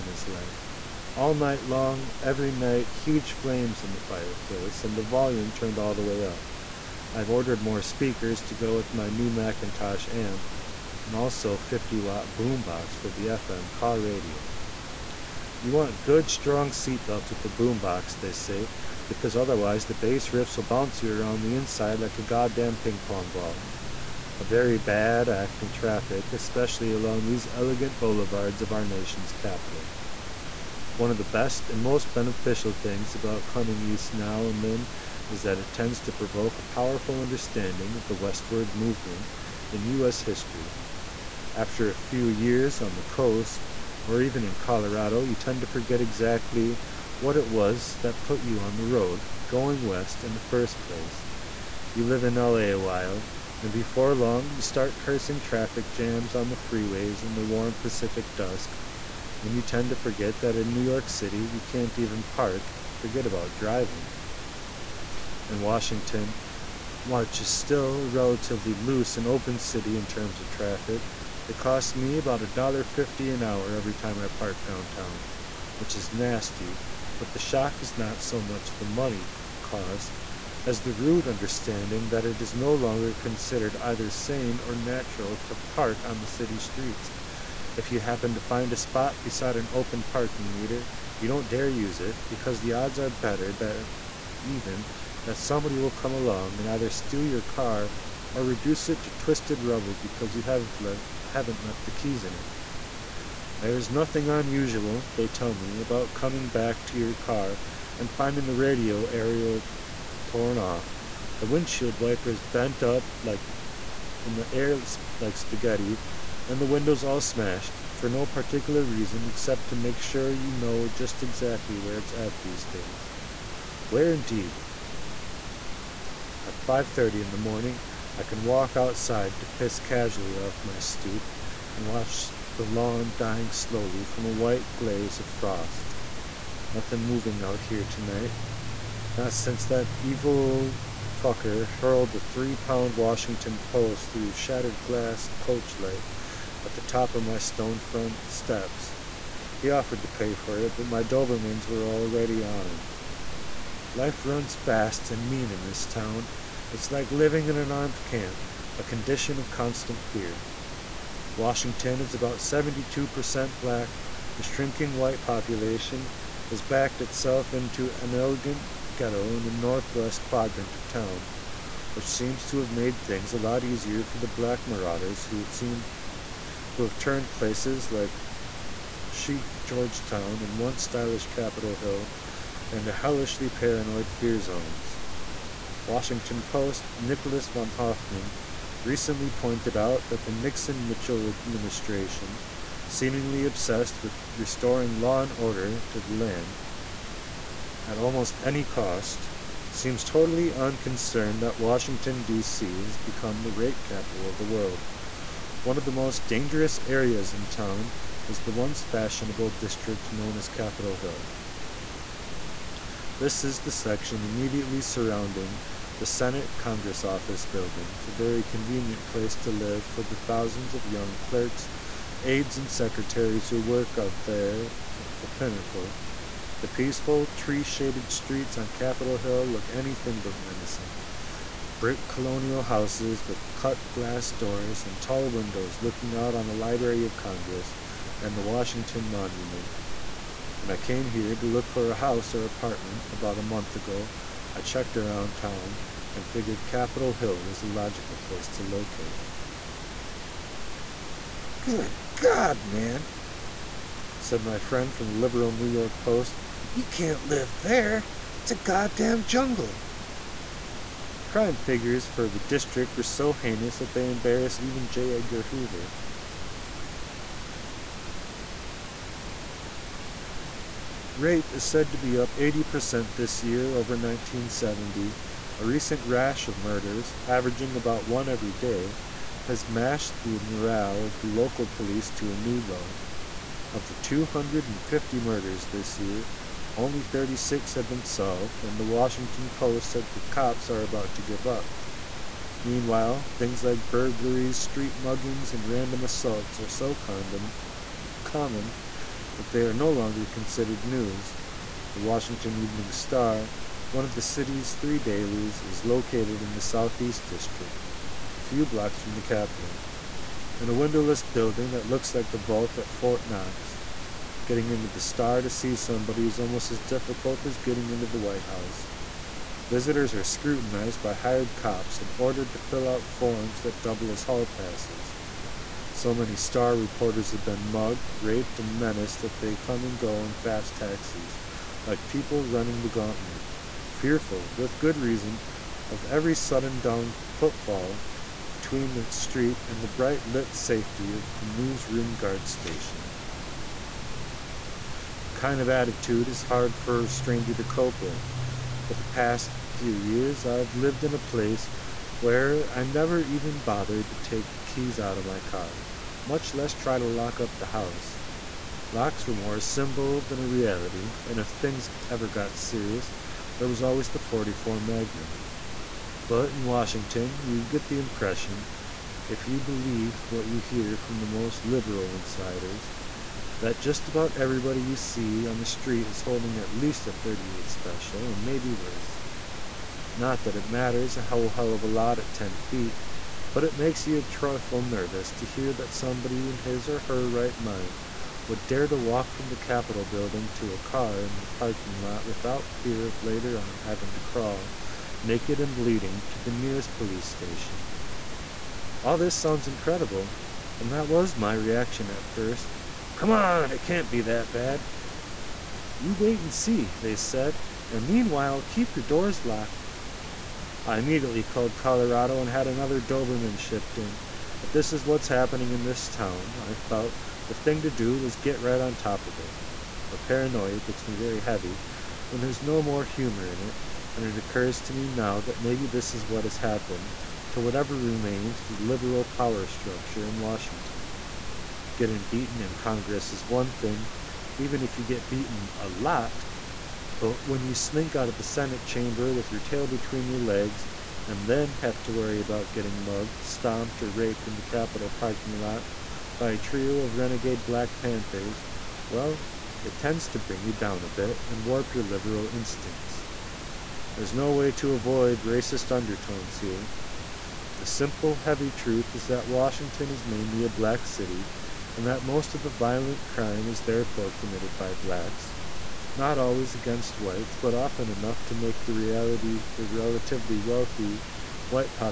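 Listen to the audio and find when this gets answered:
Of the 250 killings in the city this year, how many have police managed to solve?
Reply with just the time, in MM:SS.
04:47.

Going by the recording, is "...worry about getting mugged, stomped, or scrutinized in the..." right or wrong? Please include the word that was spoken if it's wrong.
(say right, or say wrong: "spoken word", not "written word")
wrong: "raped", not "scrutinized".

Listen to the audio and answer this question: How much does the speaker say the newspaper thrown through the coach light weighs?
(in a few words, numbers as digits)
3 pounds.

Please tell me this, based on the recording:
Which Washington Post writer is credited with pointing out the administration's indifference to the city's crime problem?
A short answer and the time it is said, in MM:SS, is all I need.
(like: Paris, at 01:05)
Nicholas von Hoffman, at 03:06.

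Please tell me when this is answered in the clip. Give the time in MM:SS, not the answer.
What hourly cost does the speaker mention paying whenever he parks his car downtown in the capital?
01:12.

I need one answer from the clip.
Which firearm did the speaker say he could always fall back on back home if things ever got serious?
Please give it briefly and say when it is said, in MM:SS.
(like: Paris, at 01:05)
44 Magnum, at 06:04.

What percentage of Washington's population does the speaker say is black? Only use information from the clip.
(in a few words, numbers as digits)
72%.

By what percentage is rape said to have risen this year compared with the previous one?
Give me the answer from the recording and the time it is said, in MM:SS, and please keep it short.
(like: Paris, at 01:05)
80%, at 04:32.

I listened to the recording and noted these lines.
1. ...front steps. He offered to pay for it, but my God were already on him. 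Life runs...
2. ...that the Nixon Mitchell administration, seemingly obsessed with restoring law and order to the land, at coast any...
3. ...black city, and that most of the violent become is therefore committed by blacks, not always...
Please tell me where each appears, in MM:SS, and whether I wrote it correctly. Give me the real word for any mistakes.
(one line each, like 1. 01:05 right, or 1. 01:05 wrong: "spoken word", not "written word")
1. 02:27 wrong: "Dobermans", not "God"
2. 03:10 wrong: "almost", not "coast"
3. 07:40 wrong: "crime", not "become".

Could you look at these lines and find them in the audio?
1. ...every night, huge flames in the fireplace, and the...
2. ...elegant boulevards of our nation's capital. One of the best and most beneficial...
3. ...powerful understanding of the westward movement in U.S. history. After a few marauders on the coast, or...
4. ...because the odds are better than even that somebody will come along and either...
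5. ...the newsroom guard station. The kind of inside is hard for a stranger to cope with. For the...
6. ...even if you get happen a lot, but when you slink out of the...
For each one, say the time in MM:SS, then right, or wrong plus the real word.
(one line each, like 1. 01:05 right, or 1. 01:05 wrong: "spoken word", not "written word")
1. 00:02 right
2. 00:27 right
3. 00:36 wrong: "years", not "marauders"
4. 01:32 right
5. 05:41 wrong: "attitude", not "inside"
6. 07:14 wrong: "beaten", not "happen".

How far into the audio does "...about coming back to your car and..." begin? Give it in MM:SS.
01:45.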